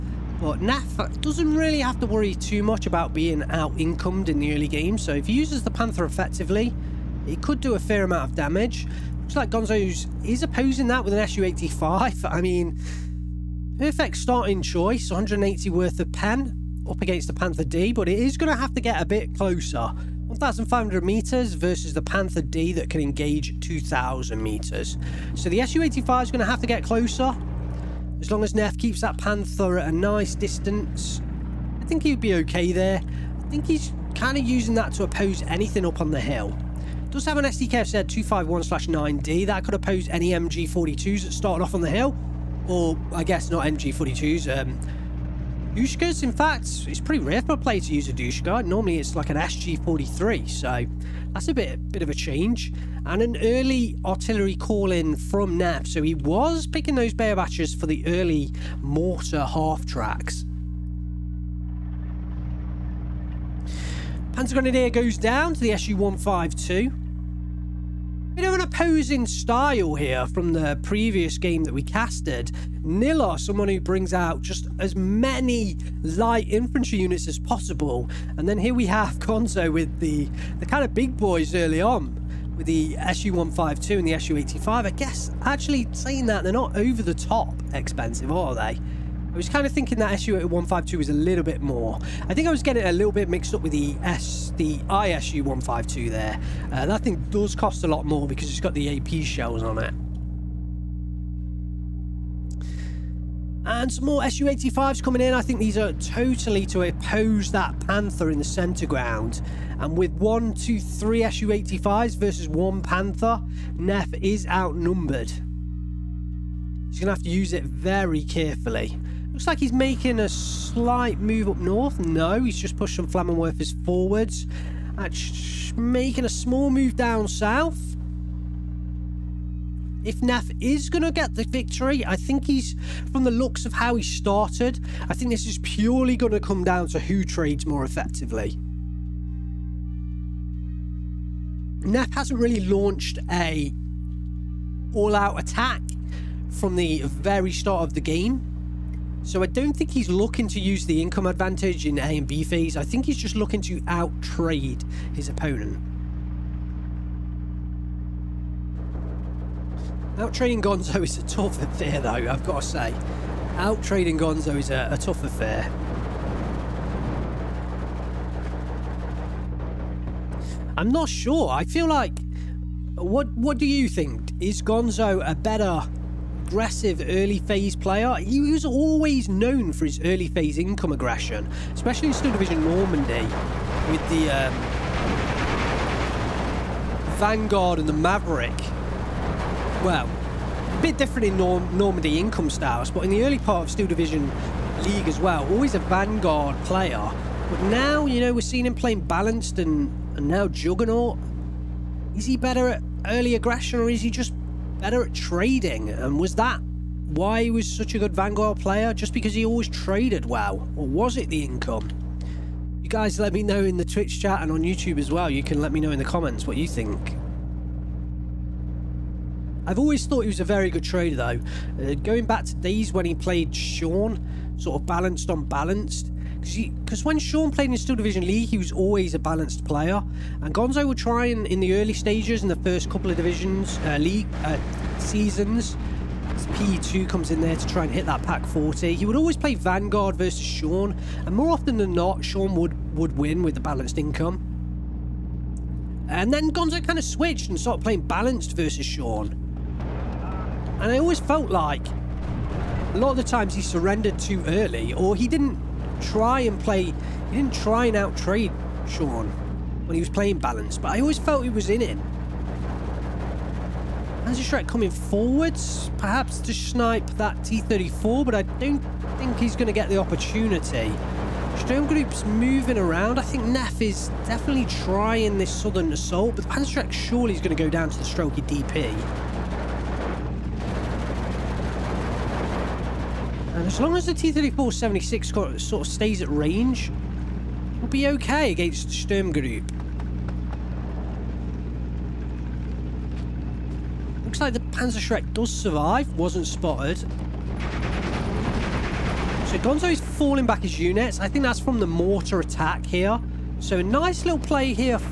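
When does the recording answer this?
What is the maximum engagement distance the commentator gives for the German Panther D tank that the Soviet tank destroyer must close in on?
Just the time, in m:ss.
0:23.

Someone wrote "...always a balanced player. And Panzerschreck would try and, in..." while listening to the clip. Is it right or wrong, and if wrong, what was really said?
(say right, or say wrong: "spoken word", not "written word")
wrong: "Gonzo", not "Panzerschreck".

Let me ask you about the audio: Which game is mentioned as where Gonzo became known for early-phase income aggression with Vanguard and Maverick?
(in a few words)
Steel Division Normandy.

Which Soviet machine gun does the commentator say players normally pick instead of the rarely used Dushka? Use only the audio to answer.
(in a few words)
SG-43.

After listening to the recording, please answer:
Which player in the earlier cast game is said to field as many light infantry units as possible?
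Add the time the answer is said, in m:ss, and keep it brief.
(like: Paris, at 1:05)
Nilla, at 1:12.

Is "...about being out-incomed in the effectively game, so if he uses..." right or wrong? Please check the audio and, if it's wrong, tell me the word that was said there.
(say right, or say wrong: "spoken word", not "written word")
wrong: "early", not "effectively".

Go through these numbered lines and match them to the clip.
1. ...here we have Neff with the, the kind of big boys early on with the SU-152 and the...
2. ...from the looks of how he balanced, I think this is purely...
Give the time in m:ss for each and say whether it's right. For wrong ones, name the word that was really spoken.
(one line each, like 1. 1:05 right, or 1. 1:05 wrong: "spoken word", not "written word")
1. 1:18 wrong: "Gonzo", not "Neff"
2. 2:13 wrong: "started", not "balanced".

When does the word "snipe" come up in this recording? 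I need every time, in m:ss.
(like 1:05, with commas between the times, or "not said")
4:26.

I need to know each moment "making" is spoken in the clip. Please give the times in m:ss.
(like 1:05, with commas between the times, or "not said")
1:59, 2:05.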